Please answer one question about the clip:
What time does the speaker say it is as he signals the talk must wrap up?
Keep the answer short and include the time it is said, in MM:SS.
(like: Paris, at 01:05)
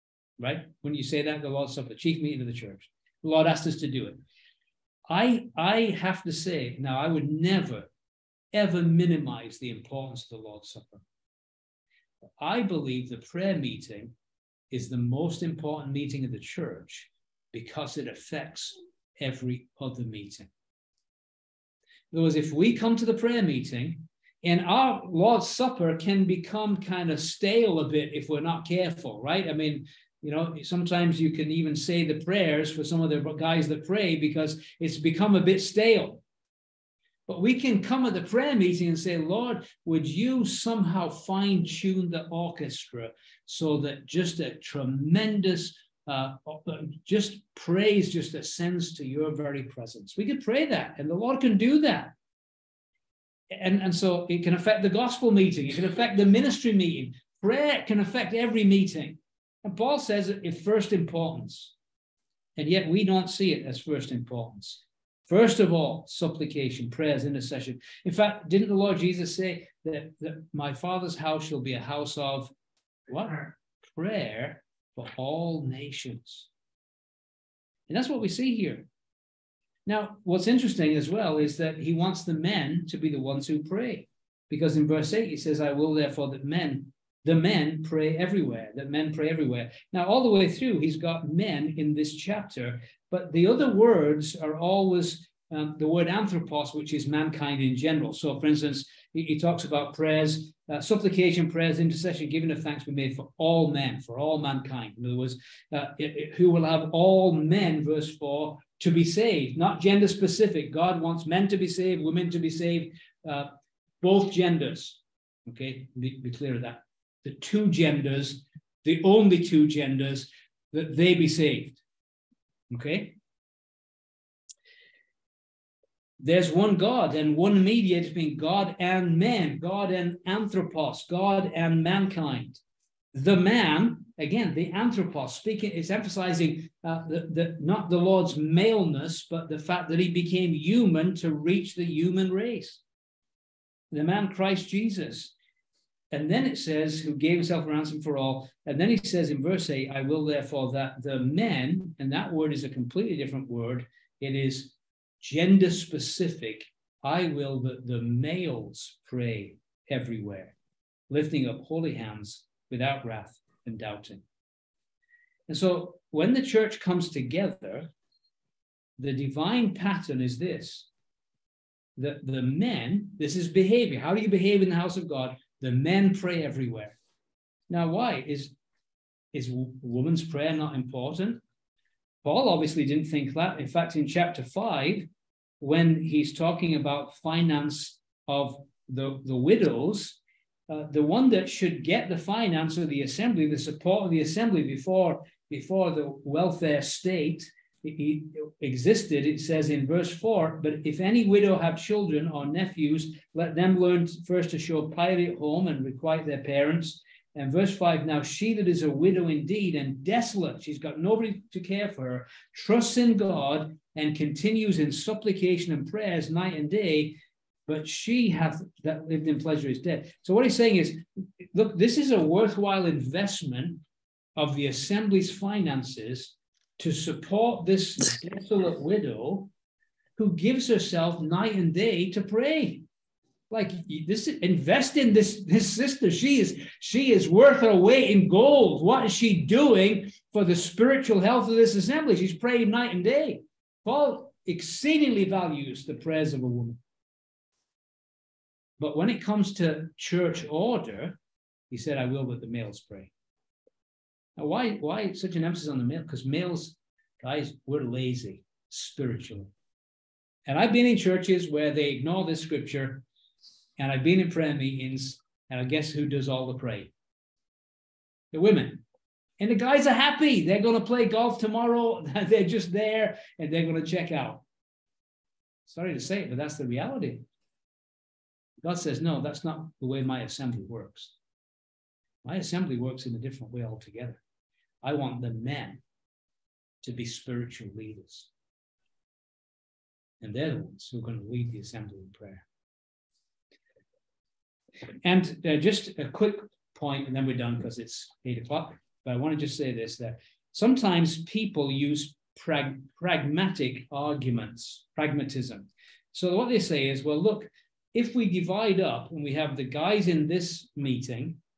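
8 o'clock, at 04:58.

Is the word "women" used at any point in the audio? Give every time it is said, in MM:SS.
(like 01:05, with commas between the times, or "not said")
01:52, 04:28.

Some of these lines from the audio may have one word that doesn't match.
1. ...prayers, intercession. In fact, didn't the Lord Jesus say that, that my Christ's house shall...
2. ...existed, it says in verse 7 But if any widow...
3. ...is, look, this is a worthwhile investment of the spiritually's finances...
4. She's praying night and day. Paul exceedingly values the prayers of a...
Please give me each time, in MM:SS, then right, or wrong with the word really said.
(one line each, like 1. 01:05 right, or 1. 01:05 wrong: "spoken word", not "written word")
1. 01:06 wrong: "Father", not "Christ"
2. 03:18 wrong: "4", not "7"
3. 03:40 wrong: "assembly", not "spiritually"
4. 04:02 right.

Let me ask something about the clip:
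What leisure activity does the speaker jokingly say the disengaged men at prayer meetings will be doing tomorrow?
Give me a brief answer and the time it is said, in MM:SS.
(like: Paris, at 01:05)
Play golf, at 04:30.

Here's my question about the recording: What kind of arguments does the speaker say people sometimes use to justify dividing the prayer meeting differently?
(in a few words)
Pragmatic arguments.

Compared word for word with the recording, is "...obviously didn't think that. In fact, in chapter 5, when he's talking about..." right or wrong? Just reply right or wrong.
right.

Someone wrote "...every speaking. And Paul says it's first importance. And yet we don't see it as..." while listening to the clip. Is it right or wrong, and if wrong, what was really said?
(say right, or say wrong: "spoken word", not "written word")
wrong: "meeting", not "speaking".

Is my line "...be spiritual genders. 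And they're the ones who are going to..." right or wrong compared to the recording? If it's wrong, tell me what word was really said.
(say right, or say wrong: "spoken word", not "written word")
wrong: "leaders", not "genders".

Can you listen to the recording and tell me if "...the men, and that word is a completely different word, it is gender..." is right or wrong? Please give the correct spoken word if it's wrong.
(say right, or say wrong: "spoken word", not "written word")
right.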